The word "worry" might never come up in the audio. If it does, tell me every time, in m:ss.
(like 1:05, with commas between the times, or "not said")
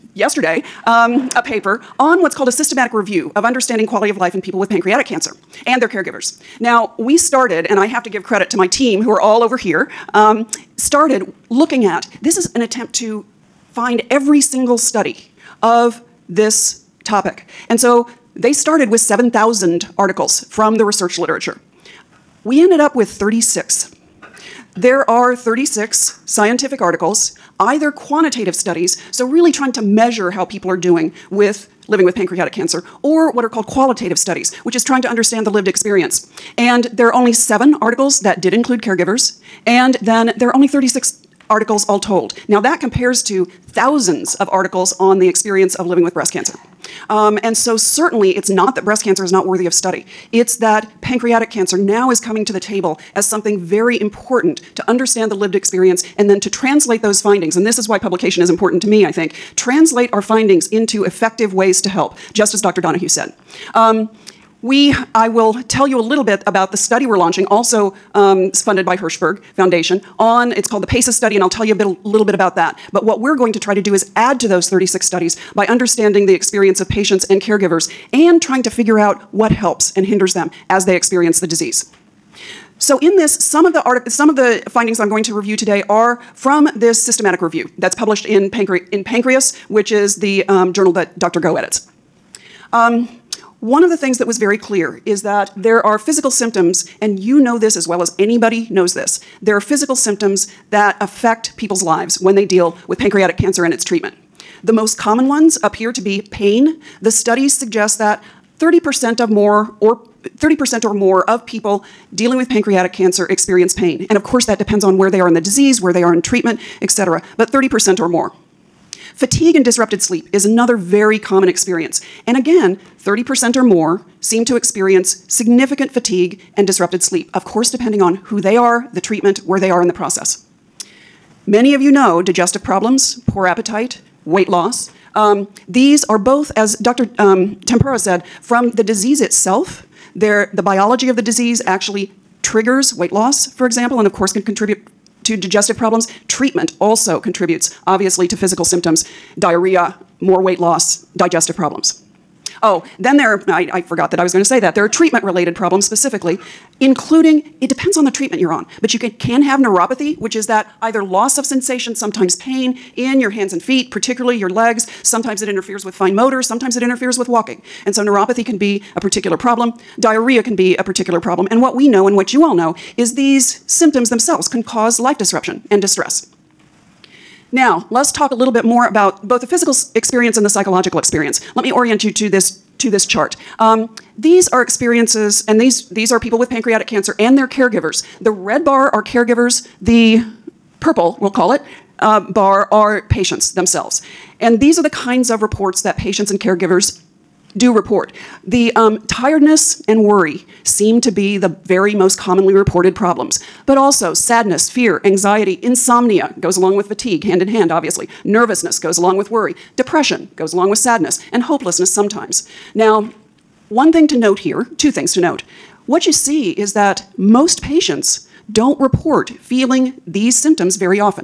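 3:20, 3:29.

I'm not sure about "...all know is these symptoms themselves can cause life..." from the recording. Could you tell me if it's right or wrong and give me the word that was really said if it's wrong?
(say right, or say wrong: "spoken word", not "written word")
right.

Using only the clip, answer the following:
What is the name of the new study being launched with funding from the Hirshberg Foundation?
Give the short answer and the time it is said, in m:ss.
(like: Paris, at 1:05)
PACES, at 1:10.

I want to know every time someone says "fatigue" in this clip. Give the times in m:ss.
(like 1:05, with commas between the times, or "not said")
1:59, 2:05, 3:26.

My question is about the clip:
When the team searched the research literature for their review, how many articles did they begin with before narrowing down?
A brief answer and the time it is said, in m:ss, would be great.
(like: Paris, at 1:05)
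7,000, at 0:18.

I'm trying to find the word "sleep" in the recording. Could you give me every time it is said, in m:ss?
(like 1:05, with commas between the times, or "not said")
1:59, 2:07.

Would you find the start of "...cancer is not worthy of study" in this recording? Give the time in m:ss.
0:49.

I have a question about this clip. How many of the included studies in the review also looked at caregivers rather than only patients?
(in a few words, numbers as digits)
7.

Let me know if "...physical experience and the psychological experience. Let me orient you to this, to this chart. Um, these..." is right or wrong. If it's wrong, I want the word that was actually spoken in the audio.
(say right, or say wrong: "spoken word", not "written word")
right.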